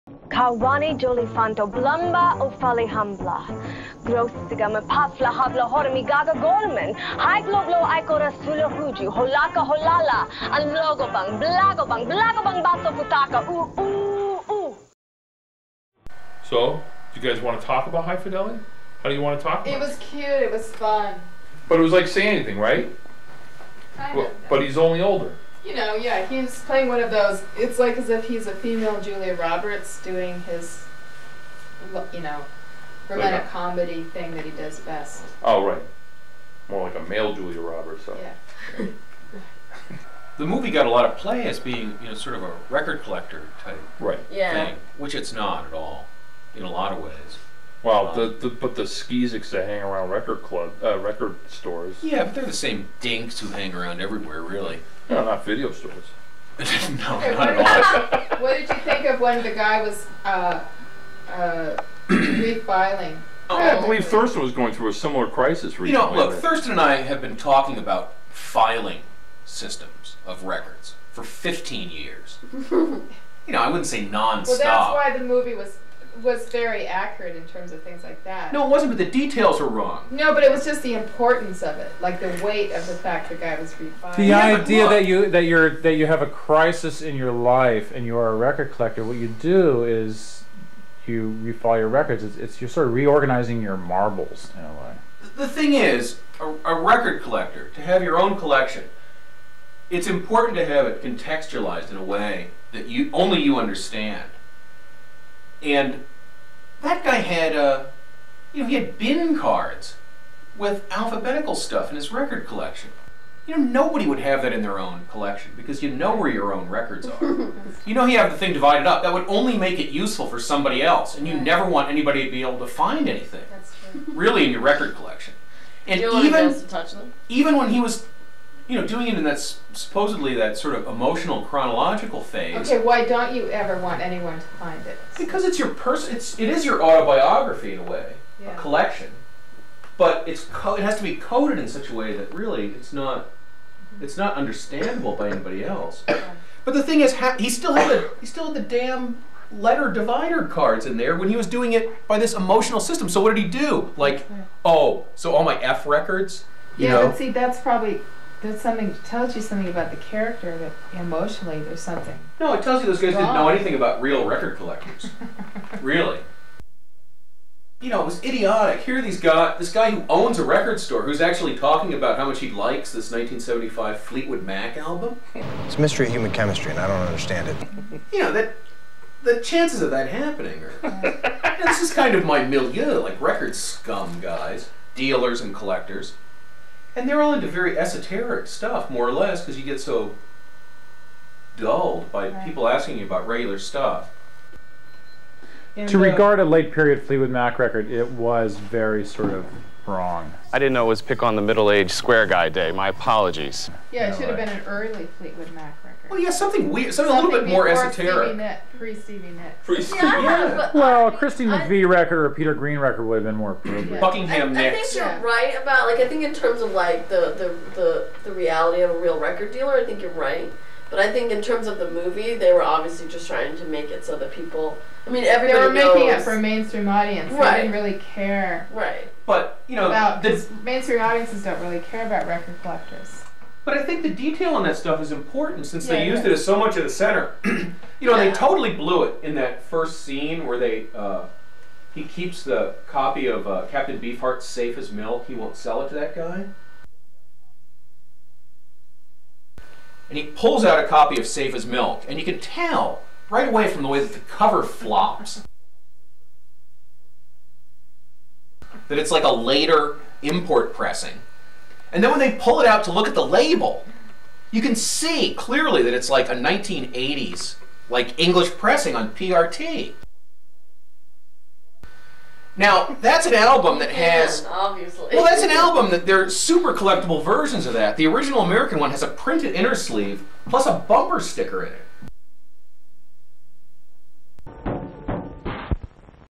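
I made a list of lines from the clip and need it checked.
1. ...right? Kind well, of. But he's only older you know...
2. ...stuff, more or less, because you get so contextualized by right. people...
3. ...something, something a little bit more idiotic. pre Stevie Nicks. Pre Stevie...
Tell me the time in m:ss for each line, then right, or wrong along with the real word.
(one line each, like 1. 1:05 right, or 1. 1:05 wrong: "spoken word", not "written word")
1. 0:22 right
2. 3:08 wrong: "dulled", not "contextualized"
3. 3:26 wrong: "esoteric", not "idiotic".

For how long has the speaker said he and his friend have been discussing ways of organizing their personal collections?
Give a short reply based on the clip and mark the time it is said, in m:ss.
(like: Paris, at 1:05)
15 years, at 1:11.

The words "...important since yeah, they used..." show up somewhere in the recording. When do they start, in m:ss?
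3:55.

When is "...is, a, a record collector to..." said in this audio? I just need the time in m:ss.
1:35.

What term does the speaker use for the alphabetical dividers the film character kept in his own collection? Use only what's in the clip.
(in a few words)
bin cards.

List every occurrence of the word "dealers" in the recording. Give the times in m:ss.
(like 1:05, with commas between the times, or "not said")
3:04, 3:39.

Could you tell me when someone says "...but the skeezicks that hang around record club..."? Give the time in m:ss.
0:48.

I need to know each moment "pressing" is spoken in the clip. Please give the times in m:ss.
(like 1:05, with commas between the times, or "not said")
4:20, 4:28.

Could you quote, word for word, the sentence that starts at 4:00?
Uh, he keeps the copy of uh, Captain Beefheart's safe as milk.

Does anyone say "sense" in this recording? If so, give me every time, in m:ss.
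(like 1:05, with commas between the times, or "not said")
not said.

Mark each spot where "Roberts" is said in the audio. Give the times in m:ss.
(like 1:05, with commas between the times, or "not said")
0:29, 0:37.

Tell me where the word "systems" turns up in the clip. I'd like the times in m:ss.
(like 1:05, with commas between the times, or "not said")
1:09, 2:32.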